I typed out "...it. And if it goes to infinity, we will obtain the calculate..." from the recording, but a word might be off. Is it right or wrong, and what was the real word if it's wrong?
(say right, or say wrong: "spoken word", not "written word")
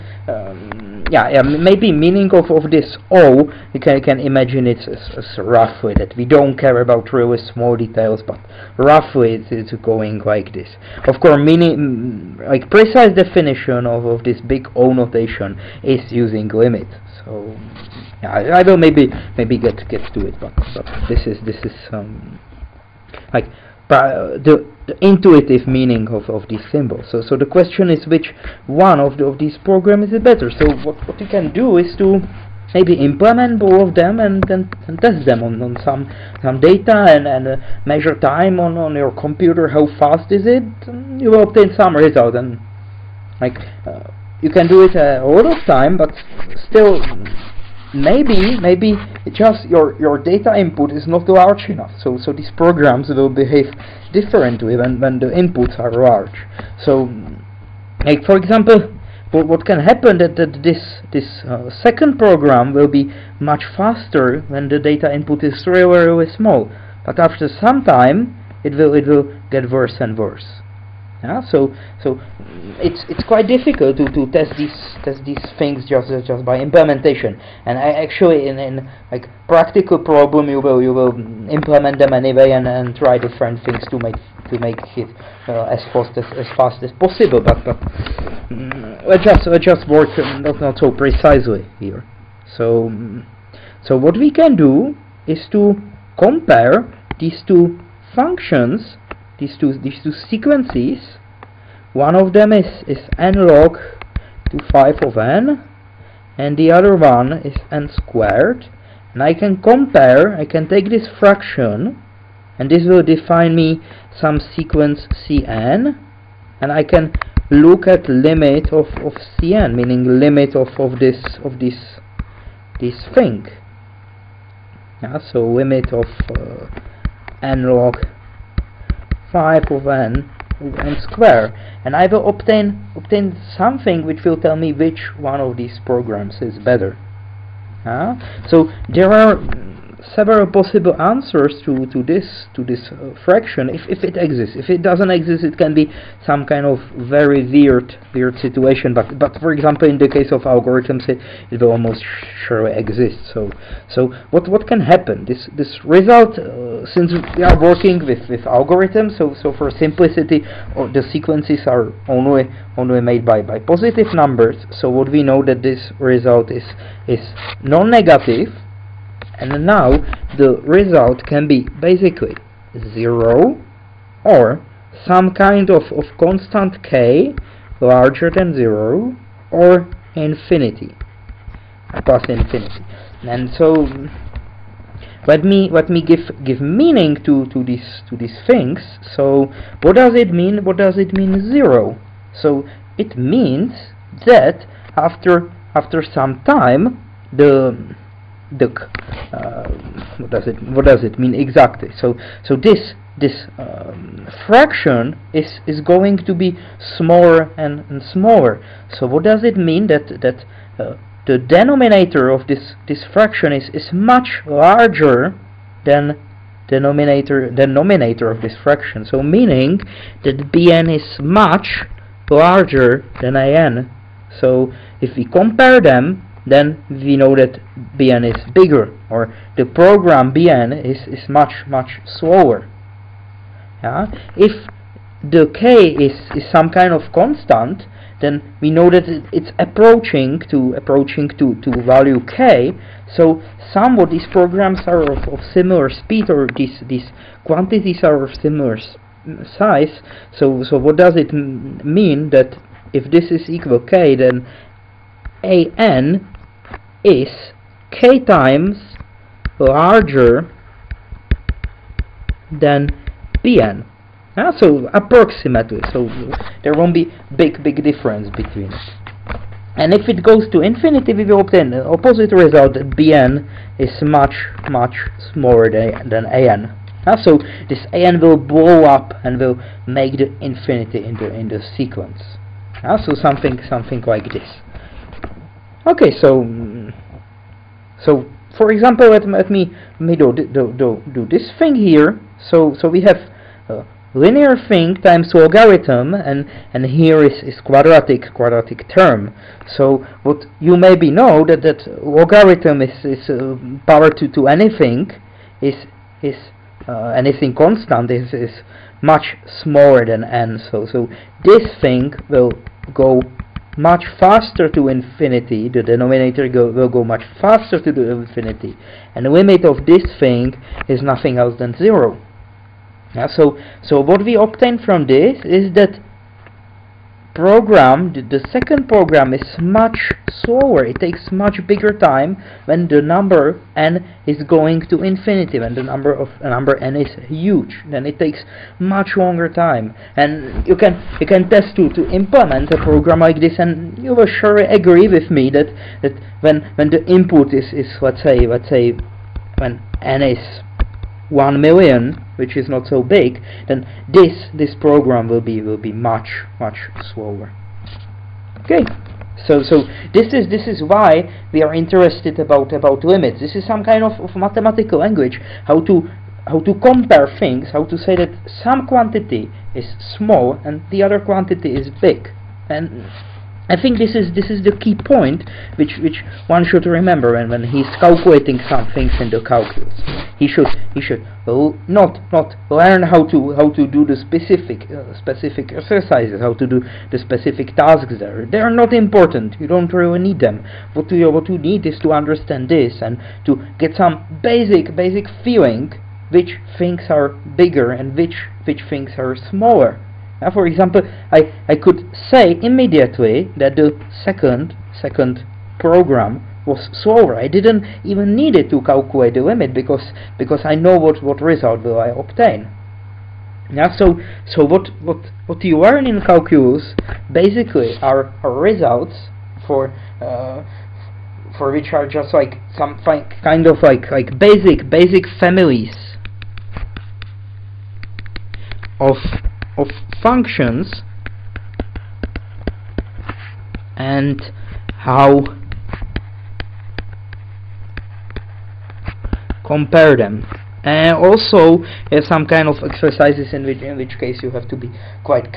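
wrong: "opposite", not "calculate".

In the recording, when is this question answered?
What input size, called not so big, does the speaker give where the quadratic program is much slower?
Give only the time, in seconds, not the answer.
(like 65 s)
351 s.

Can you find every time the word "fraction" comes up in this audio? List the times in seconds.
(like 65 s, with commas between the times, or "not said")
111 s, 143 s, 204 s, 213 s, 218 s.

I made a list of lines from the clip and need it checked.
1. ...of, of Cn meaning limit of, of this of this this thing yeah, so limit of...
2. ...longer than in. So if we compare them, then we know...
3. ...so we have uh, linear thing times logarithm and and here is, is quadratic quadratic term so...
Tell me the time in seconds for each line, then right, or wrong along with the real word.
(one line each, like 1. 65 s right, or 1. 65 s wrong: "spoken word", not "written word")
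1. 118 s right
2. 222 s wrong: "larger", not "longer"
3. 292 s right.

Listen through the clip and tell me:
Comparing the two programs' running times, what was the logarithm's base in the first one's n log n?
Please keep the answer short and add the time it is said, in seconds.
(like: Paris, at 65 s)
5, at 103 s.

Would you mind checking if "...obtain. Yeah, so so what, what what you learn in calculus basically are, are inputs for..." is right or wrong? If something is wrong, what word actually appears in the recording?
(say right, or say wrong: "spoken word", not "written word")
wrong: "results", not "inputs".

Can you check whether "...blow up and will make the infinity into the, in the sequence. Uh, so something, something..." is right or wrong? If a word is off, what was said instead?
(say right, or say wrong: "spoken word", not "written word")
right.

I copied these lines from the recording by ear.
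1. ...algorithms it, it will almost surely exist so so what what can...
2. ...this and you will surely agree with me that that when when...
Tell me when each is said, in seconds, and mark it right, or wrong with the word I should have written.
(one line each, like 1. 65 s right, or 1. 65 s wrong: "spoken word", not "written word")
1. 150 s right
2. 343 s right.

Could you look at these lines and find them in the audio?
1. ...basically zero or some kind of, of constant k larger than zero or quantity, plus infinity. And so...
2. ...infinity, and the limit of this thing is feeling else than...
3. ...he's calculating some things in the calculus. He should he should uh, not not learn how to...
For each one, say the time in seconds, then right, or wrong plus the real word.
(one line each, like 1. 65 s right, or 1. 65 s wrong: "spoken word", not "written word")
1. 171 s wrong: "infinity", not "quantity"
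2. 318 s wrong: "nothing", not "feeling"
3. 377 s right.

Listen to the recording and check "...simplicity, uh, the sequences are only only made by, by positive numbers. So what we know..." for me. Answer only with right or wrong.
right.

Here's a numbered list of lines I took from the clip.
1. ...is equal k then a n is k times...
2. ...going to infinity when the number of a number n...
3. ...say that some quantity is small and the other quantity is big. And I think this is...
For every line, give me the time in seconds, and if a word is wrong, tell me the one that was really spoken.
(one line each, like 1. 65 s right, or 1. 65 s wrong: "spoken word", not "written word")
1. 253 s right
2. 334 s right
3. 367 s right.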